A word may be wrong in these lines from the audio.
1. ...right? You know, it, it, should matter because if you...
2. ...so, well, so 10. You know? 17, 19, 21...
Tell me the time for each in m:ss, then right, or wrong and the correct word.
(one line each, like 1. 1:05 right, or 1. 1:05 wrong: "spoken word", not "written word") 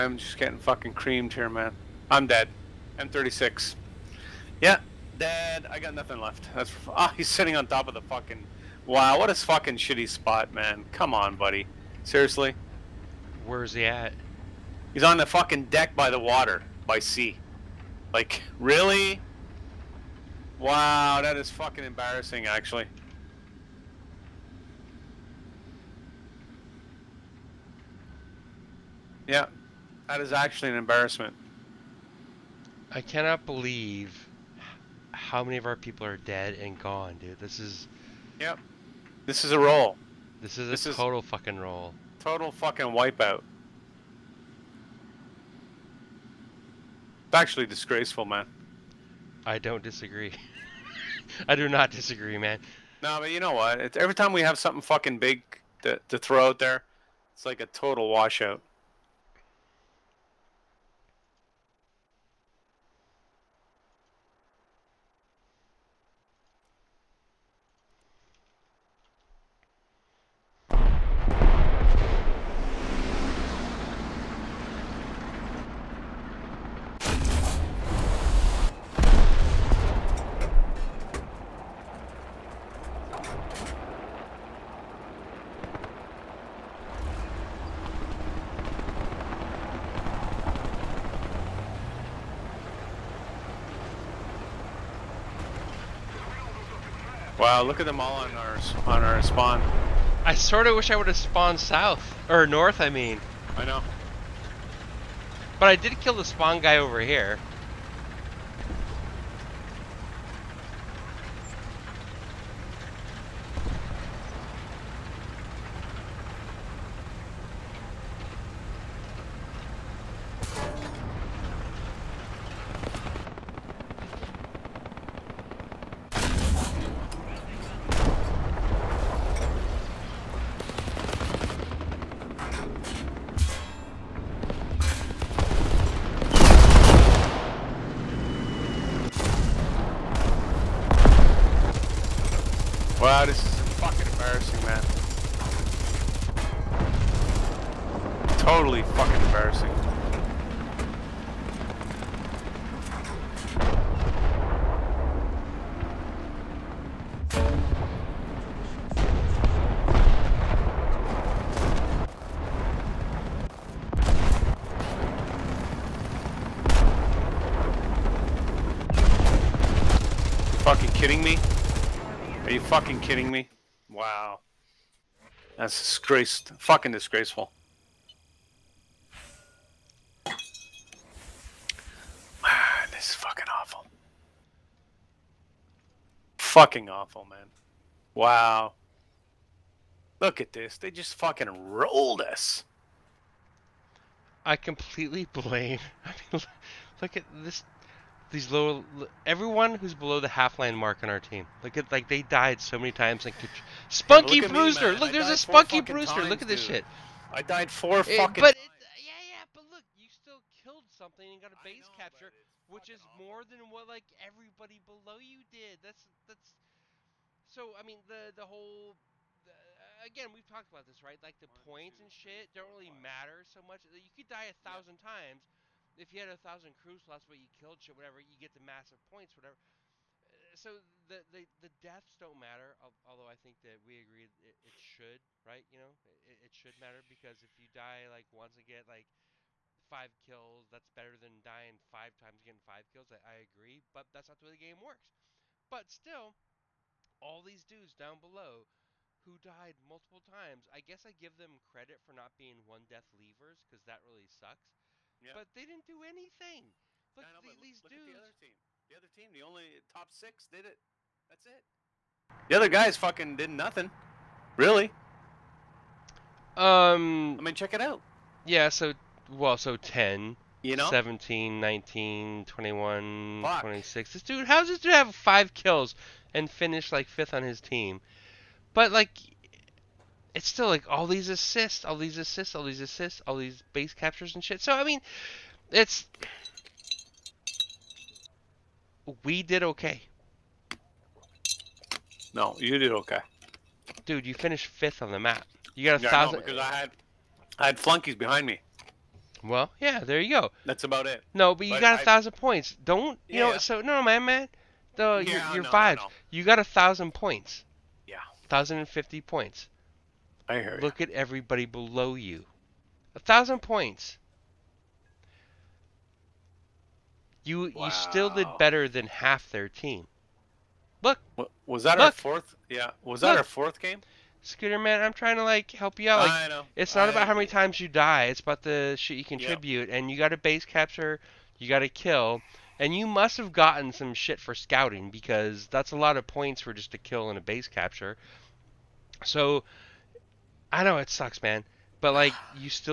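1. 3:55 right
2. 4:28 right.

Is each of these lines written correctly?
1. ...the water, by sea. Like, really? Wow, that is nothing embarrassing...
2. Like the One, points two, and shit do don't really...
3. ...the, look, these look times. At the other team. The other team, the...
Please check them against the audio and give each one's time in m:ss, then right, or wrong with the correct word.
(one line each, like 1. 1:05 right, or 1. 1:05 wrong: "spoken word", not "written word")
1. 0:16 wrong: "fucking", not "nothing"
2. 3:41 right
3. 4:17 wrong: "dudes", not "times".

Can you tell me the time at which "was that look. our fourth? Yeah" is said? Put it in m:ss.
5:21.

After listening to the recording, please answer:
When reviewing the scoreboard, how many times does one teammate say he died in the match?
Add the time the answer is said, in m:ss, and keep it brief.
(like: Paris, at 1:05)
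4, at 3:27.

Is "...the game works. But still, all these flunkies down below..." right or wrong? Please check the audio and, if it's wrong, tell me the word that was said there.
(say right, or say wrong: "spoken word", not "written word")
wrong: "dudes", not "flunkies".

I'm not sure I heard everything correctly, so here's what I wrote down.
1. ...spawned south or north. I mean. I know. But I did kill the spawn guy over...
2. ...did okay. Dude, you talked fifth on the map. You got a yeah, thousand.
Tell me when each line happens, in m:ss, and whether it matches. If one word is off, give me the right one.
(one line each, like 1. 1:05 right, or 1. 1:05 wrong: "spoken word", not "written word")
1. 1:41 right
2. 4:52 wrong: "finished", not "talked".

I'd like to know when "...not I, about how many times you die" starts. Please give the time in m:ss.
5:26.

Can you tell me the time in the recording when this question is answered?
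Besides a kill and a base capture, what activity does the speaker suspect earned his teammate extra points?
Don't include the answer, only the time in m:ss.
5:34.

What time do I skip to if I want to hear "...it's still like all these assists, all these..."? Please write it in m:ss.
4:40.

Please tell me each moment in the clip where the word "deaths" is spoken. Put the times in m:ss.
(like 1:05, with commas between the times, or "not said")
3:51, 4:12.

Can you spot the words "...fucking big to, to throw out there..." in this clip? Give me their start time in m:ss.
0:54.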